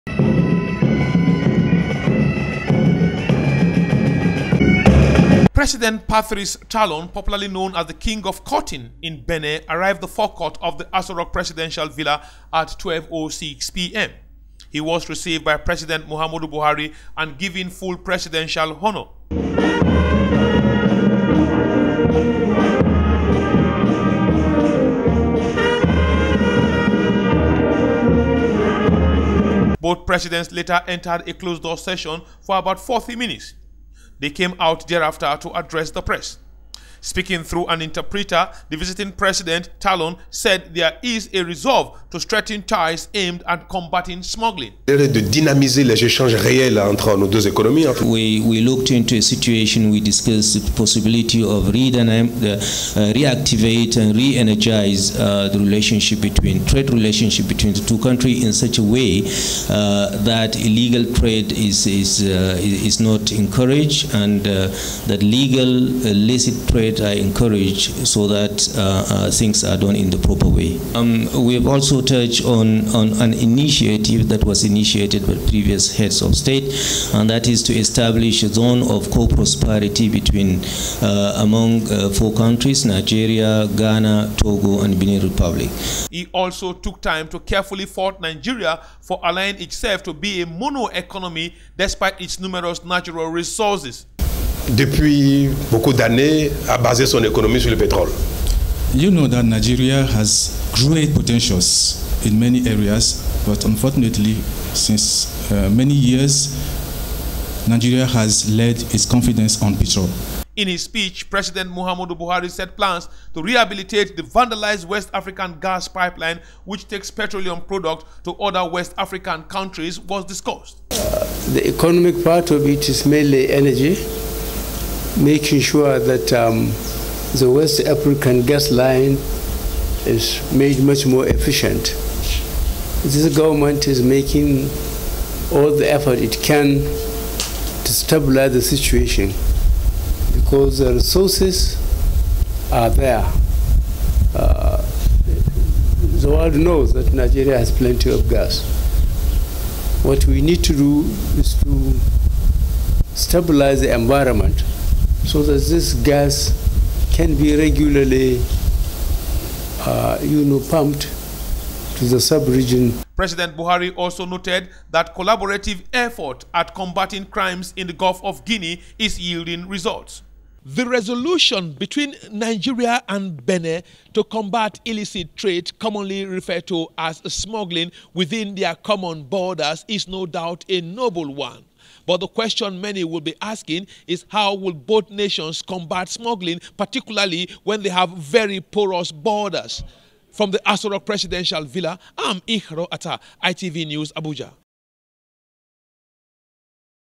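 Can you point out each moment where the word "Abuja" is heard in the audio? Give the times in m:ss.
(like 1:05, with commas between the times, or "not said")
3:14.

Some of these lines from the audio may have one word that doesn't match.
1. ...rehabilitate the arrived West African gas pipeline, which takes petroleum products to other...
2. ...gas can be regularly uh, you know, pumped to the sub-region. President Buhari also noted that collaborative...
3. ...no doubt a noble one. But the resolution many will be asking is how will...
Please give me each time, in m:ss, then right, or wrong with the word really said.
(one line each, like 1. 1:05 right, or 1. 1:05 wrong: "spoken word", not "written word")
1. 1:53 wrong: "vandalized", not "arrived"
2. 2:35 right
3. 3:00 wrong: "question", not "resolution".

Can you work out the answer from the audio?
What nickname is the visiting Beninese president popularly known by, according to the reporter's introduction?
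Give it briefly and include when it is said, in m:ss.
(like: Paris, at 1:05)
King of Cotton, at 0:07.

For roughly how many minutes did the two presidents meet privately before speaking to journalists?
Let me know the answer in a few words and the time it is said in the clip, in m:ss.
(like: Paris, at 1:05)
40 minutes, at 0:32.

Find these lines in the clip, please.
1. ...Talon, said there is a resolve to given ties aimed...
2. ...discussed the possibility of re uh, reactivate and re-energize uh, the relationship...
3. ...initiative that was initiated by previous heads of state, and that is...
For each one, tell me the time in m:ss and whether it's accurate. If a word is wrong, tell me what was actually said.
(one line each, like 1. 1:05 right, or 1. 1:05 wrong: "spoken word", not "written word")
1. 0:39 wrong: "strengthen", not "given"
2. 0:49 right
3. 1:13 right.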